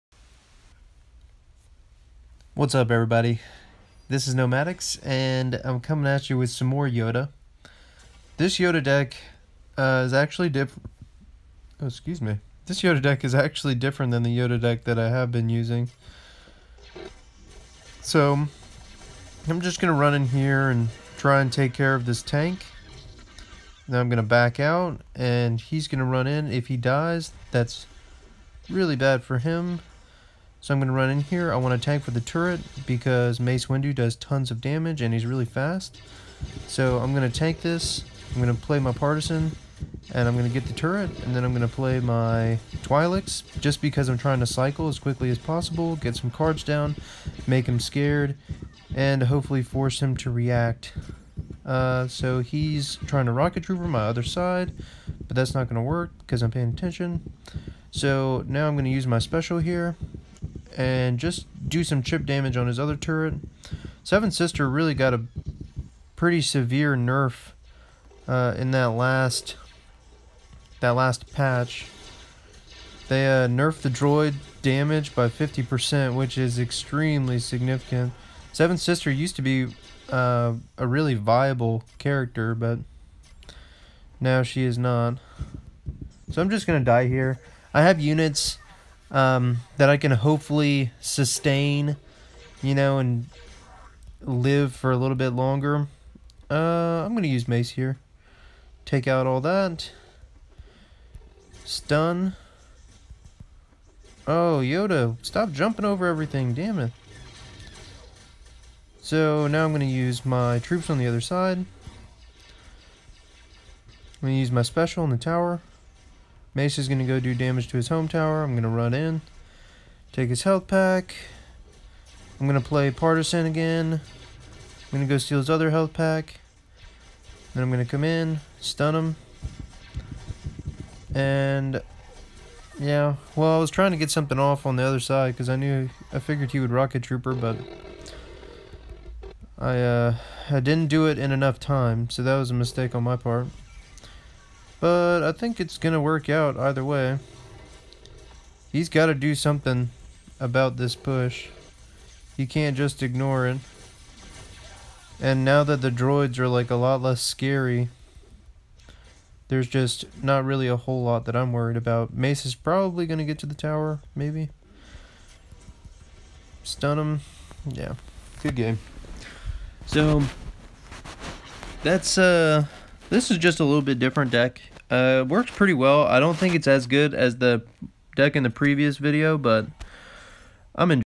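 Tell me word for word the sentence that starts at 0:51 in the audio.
Uh, so he's trying to rocket trooper my other side, but that's not going to work because I'm paying attention.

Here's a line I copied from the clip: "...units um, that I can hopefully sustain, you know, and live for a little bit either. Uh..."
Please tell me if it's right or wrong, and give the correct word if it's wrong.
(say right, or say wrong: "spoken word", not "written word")
wrong: "longer", not "either".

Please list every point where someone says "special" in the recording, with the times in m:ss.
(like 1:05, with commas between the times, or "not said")
0:59, 1:54.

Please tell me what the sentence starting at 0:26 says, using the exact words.
If he dies, that's really bad for him so I'm going to run in here.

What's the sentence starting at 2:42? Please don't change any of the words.
Mace is probably going to get to the tower, maybe.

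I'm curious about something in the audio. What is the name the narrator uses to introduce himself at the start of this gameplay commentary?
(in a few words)
Nomadics.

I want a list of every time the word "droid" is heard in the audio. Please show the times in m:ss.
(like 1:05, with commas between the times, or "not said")
1:13, 2:35.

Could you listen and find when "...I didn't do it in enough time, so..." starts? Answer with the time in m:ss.
2:20.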